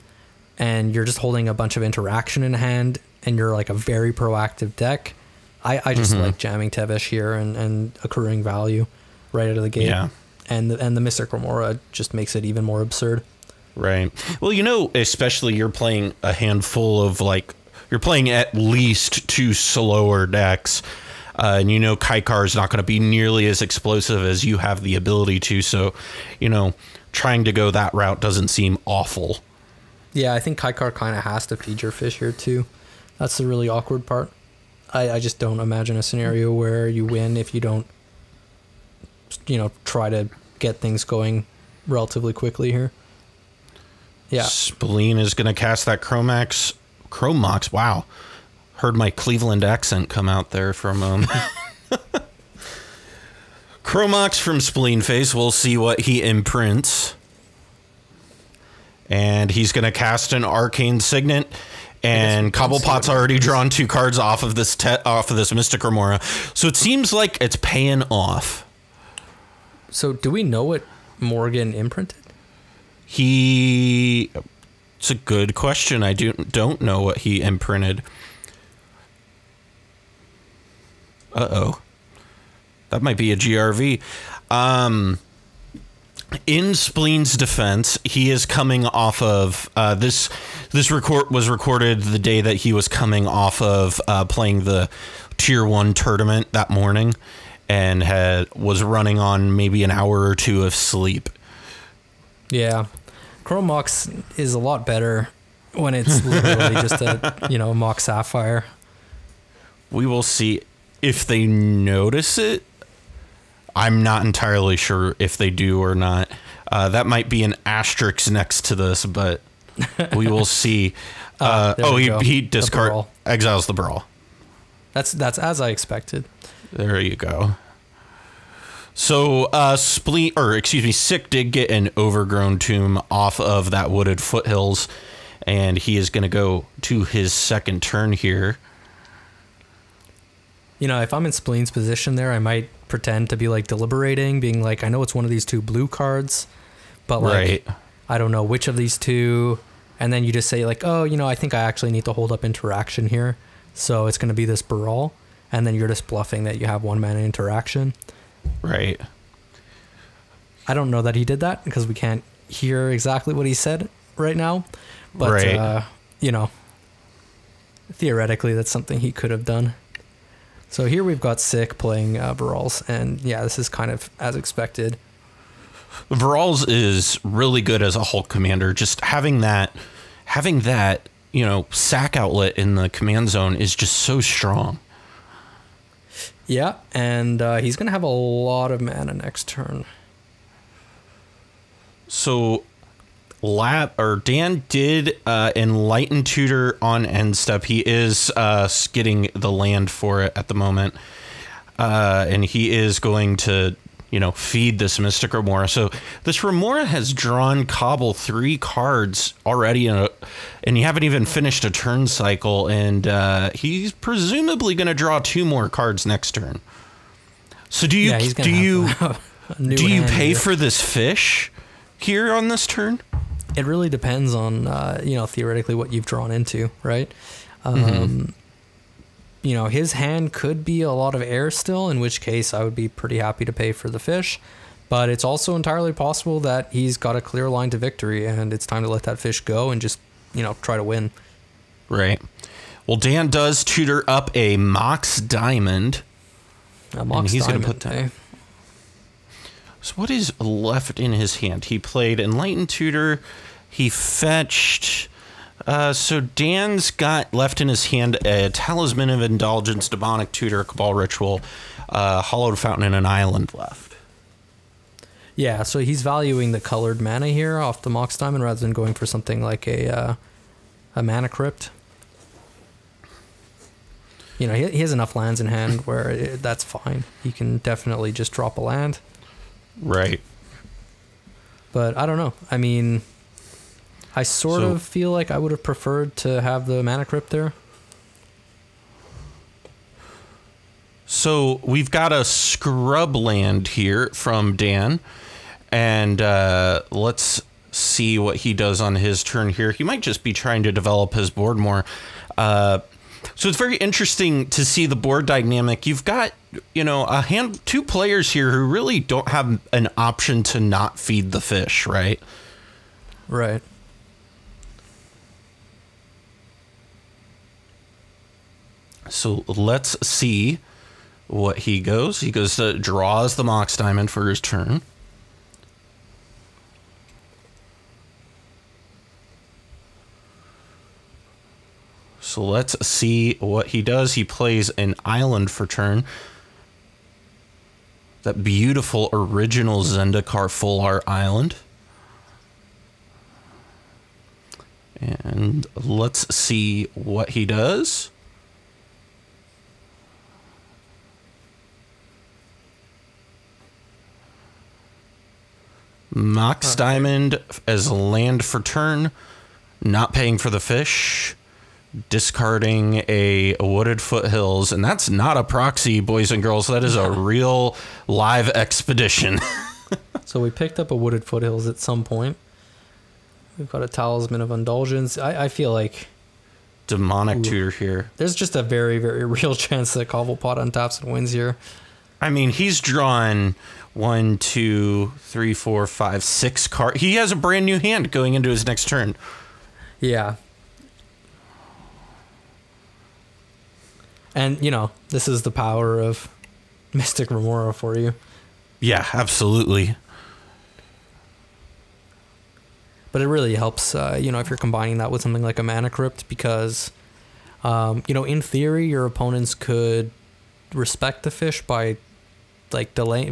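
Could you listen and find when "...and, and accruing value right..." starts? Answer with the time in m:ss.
0:07.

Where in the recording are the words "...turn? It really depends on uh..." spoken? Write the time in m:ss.
3:42.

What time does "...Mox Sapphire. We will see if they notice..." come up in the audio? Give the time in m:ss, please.
1:47.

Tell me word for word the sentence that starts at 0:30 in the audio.
Yeah, I think Kykar kind of has to feed your fish here too.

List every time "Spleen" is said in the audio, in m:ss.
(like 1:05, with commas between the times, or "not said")
0:44, 0:54, 1:26, 2:09, 2:21.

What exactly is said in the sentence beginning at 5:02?
Uh, so it's very interesting to see the board dynamic.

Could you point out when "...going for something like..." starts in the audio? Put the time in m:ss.
4:28.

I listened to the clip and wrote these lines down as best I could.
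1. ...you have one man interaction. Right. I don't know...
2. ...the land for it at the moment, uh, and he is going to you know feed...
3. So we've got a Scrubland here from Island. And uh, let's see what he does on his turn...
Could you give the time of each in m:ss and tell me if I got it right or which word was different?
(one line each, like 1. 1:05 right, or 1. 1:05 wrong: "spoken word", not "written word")
1. 2:36 right
2. 3:18 right
3. 4:51 wrong: "Dan", not "Island".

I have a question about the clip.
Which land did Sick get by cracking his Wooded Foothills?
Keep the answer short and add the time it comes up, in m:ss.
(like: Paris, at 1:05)
Overgrown Tomb, at 2:11.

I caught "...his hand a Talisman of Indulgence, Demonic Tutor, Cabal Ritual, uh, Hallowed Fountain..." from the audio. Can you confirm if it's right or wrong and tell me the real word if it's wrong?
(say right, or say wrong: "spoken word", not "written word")
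right.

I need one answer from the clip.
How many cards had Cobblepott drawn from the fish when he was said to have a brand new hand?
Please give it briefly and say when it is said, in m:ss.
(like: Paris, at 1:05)
6, at 6:26.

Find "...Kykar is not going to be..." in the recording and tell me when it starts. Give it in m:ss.
0:21.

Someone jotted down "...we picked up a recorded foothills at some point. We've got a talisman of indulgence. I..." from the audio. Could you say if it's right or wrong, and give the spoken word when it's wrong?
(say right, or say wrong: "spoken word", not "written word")
wrong: "wooded", not "recorded".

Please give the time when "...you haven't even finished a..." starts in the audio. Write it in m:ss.
3:30.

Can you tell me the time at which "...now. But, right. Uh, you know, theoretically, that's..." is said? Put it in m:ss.
2:44.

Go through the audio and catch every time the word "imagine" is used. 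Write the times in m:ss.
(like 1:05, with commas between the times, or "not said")
0:35.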